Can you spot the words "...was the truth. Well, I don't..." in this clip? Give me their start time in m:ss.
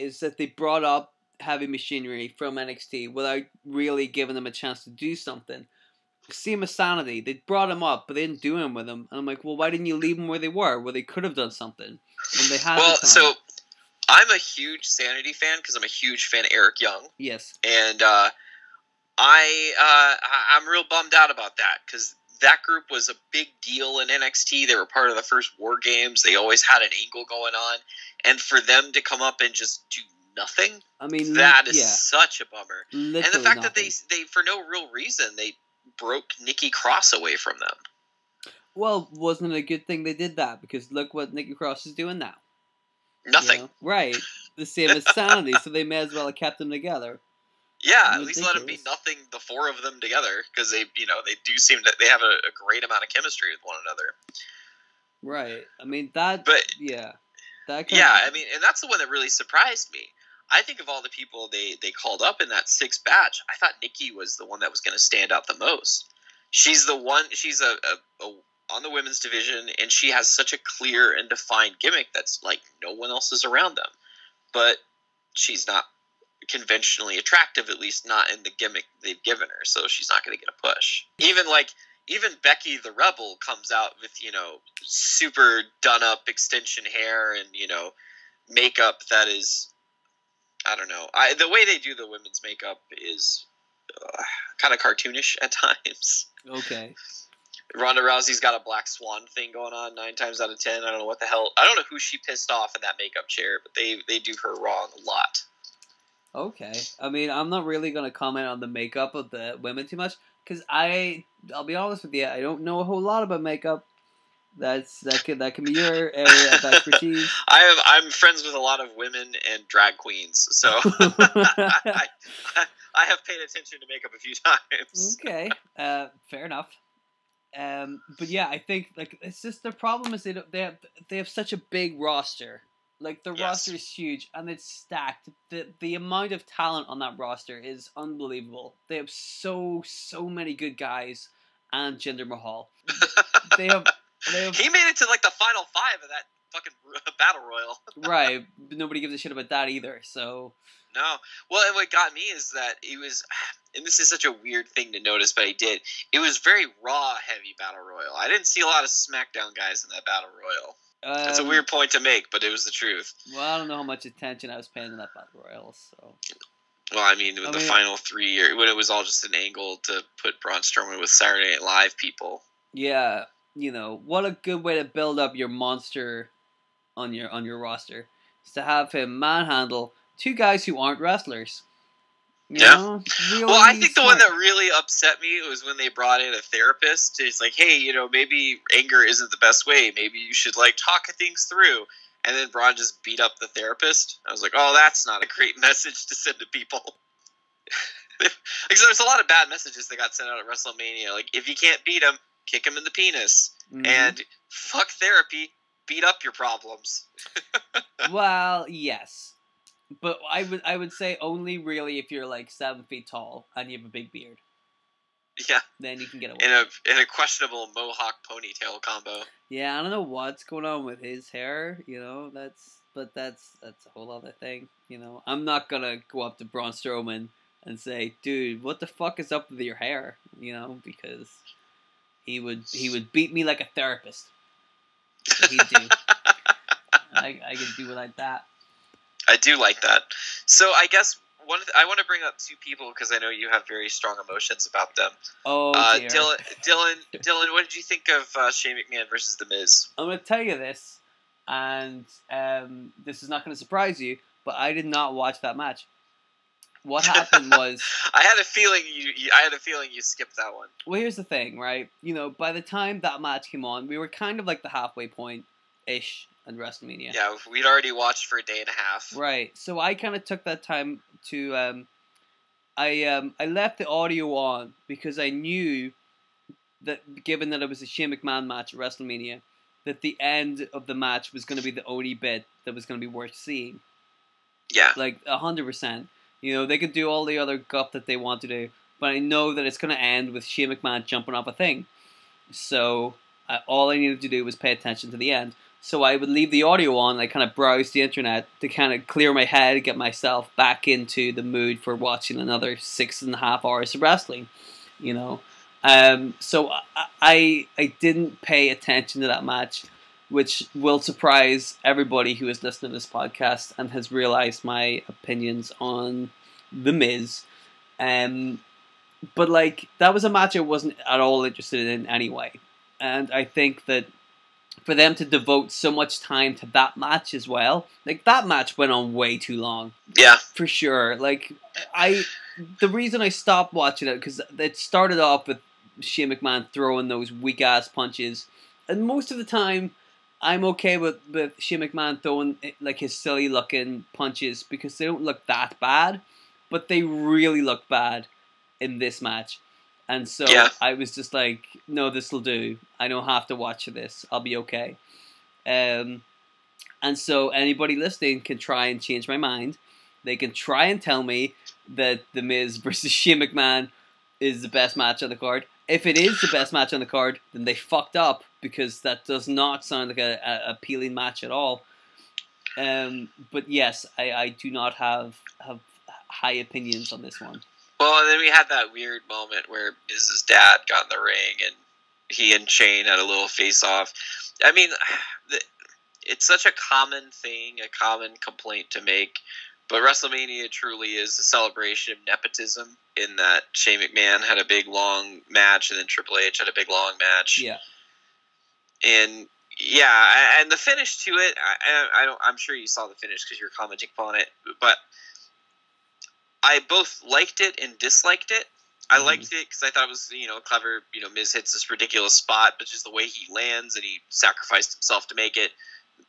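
2:42.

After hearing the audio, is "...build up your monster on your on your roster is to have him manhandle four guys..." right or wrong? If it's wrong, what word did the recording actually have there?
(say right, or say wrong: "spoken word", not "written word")
wrong: "two", not "four".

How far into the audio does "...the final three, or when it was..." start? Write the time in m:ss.
2:47.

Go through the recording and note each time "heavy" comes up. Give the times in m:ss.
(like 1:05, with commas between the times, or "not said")
0:01, 2:37.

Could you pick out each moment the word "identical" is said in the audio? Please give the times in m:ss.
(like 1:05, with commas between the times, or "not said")
not said.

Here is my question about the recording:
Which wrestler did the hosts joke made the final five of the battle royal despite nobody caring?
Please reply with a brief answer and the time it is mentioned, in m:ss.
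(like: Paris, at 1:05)
Jinder Mahal, at 2:21.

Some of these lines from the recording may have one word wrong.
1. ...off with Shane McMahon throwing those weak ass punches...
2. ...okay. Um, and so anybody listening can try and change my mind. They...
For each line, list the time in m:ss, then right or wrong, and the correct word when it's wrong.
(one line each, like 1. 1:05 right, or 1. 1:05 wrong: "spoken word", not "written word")
1. 5:35 right
2. 5:54 right.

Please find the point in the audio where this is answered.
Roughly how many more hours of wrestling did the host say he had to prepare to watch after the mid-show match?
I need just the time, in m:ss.
5:02.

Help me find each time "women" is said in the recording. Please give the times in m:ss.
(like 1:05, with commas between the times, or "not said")
1:08, 1:32, 1:49, 1:58.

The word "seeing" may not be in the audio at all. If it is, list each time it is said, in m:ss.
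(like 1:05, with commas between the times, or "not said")
4:43.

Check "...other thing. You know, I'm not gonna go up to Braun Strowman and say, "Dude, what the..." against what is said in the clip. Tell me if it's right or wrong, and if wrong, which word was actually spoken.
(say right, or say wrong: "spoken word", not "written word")
right.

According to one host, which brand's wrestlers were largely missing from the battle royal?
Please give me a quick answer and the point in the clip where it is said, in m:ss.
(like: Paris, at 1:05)
SmackDown, at 2:38.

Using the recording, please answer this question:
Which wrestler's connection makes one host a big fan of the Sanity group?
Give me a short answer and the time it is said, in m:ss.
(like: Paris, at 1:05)
Eric Young, at 0:16.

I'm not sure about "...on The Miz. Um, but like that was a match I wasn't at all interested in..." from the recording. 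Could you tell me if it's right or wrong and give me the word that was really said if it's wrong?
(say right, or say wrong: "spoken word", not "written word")
right.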